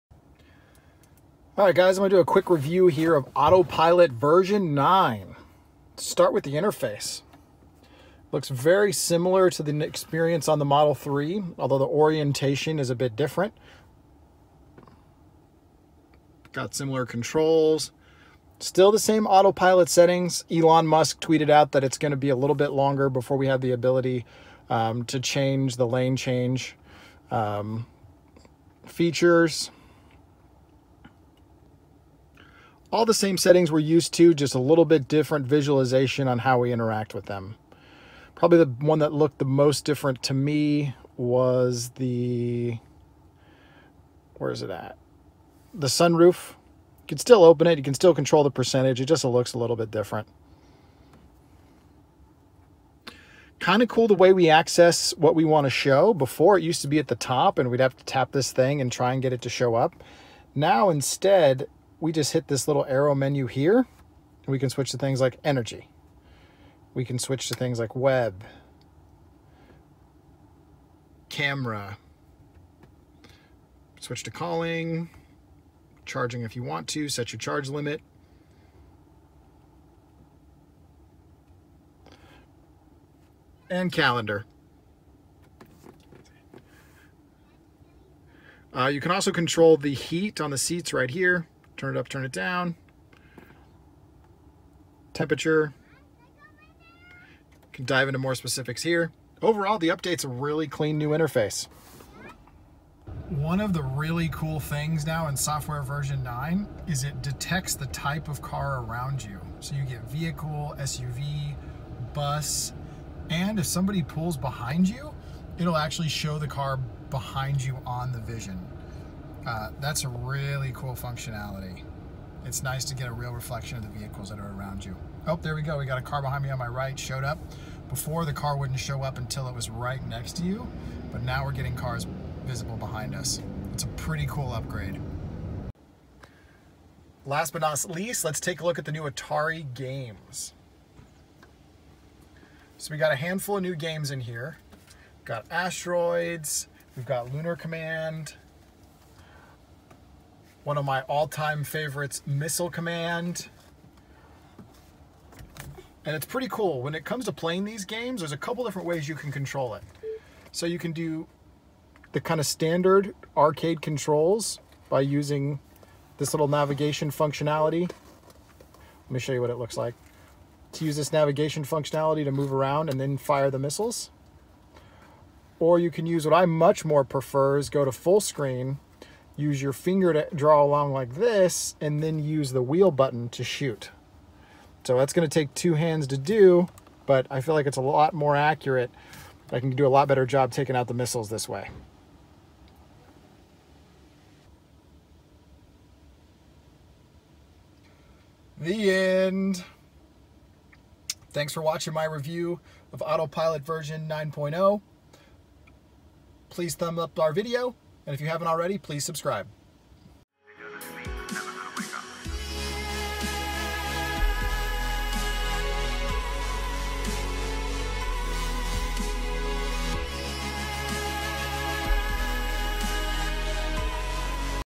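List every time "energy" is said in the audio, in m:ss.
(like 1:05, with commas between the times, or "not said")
1:05.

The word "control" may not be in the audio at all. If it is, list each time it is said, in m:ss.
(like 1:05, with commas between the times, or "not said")
0:17, 0:48, 1:29, 2:39, 2:43.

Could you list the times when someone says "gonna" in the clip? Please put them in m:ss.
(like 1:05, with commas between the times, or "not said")
0:02, 0:21, 3:05.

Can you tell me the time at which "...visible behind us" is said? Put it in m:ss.
2:12.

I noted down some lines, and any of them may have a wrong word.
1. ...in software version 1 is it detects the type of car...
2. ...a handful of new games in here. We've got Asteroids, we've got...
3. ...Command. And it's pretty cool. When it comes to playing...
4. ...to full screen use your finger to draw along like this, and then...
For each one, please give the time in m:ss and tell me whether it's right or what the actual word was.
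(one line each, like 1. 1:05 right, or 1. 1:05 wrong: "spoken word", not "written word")
1. 1:45 wrong: "9", not "1"
2. 2:23 right
3. 2:32 right
4. 2:57 right.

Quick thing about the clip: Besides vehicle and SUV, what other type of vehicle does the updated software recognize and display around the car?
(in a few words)
Bus.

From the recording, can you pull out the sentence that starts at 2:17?
Last but not least, let's take a look at the new Atari games.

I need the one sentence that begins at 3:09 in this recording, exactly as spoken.
I can do a lot better job taking out the missiles this way.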